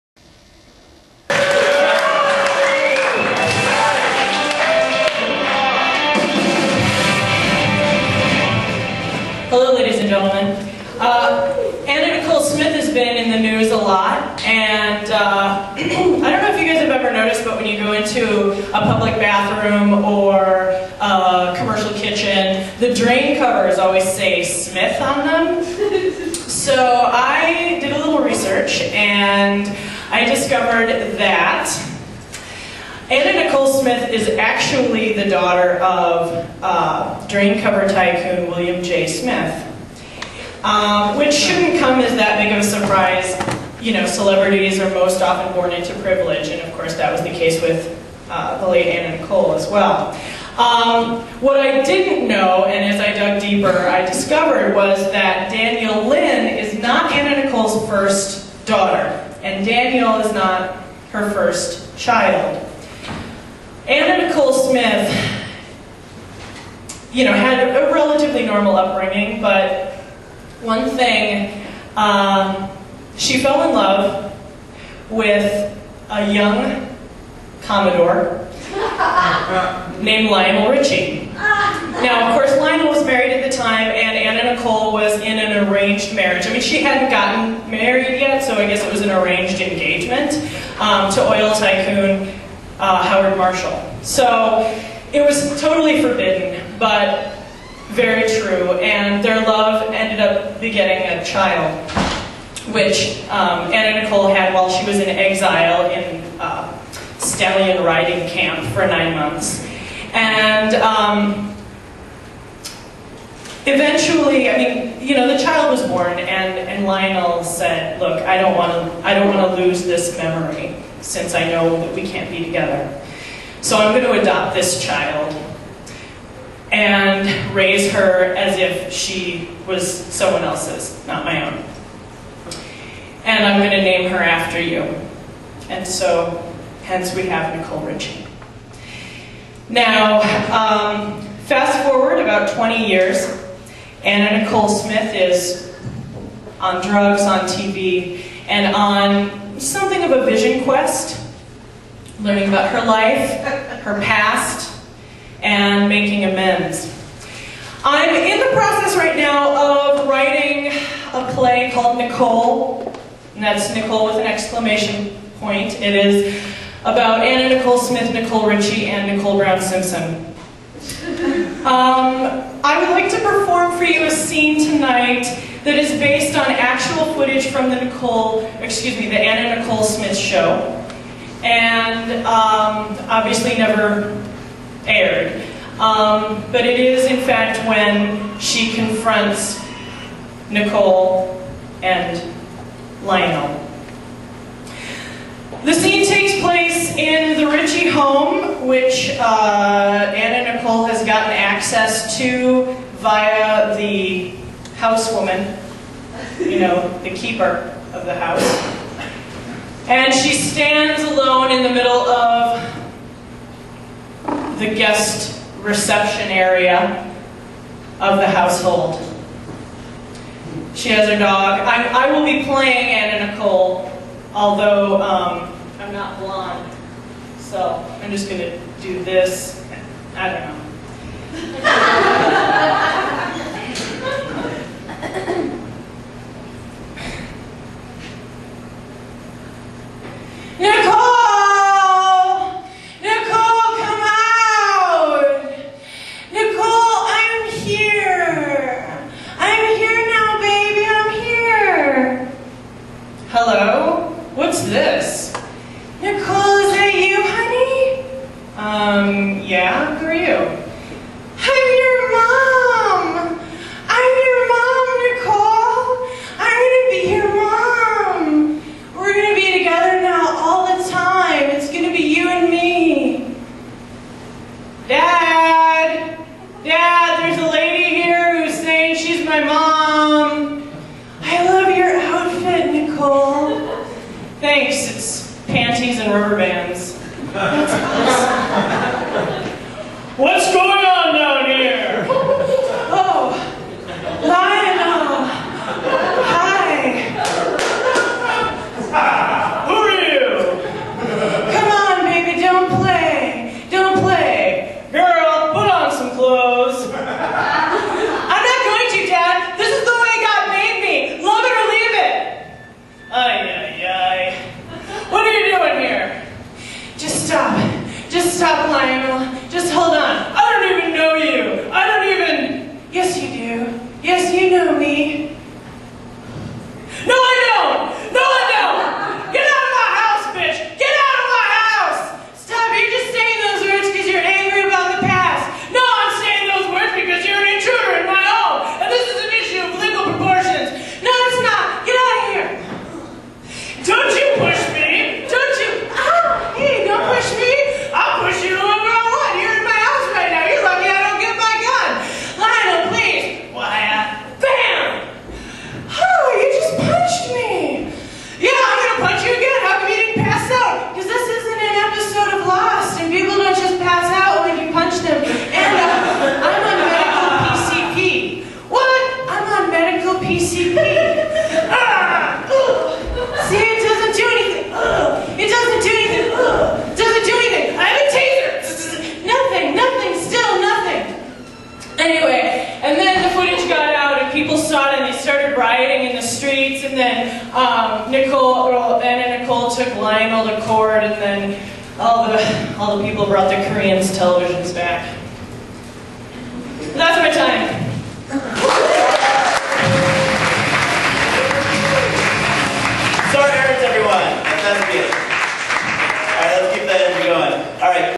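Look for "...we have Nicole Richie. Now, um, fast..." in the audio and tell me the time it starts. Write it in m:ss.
2:17.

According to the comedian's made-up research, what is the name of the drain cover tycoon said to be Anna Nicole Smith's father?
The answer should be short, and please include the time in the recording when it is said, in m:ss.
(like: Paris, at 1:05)
William J. Smith, at 0:38.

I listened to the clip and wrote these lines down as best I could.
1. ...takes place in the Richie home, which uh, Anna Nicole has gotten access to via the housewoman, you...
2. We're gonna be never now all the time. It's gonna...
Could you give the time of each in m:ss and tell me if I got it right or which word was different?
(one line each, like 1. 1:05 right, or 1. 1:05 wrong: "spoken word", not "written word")
1. 3:16 right
2. 4:28 wrong: "together", not "never".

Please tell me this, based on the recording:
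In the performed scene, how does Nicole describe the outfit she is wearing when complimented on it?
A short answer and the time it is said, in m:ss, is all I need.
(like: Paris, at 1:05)
panties and rubber bands, at 4:45.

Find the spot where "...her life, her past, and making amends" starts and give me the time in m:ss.
2:32.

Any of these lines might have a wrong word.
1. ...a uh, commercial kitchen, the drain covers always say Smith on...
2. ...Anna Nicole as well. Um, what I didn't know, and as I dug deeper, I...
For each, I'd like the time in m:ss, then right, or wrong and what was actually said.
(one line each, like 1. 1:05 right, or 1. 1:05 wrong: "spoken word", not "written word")
1. 0:20 right
2. 0:48 right.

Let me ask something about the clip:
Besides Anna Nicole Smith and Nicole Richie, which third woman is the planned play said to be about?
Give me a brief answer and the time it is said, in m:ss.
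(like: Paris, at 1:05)
Nicole Brown Simpson, at 2:49.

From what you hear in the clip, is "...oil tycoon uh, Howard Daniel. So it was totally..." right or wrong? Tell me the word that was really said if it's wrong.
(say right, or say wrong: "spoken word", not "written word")
wrong: "Marshall", not "Daniel".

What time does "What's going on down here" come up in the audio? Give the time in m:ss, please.
4:50.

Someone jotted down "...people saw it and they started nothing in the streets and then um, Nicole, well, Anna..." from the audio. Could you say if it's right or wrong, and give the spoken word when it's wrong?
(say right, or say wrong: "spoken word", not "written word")
wrong: "rioting", not "nothing".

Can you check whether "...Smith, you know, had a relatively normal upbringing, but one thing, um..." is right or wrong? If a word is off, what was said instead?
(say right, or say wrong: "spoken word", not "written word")
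right.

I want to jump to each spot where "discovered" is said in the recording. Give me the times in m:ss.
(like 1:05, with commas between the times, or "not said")
0:30, 0:54.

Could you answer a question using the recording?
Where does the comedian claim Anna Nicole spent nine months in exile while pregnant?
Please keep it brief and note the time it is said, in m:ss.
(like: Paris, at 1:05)
stallion riding camp, at 1:47.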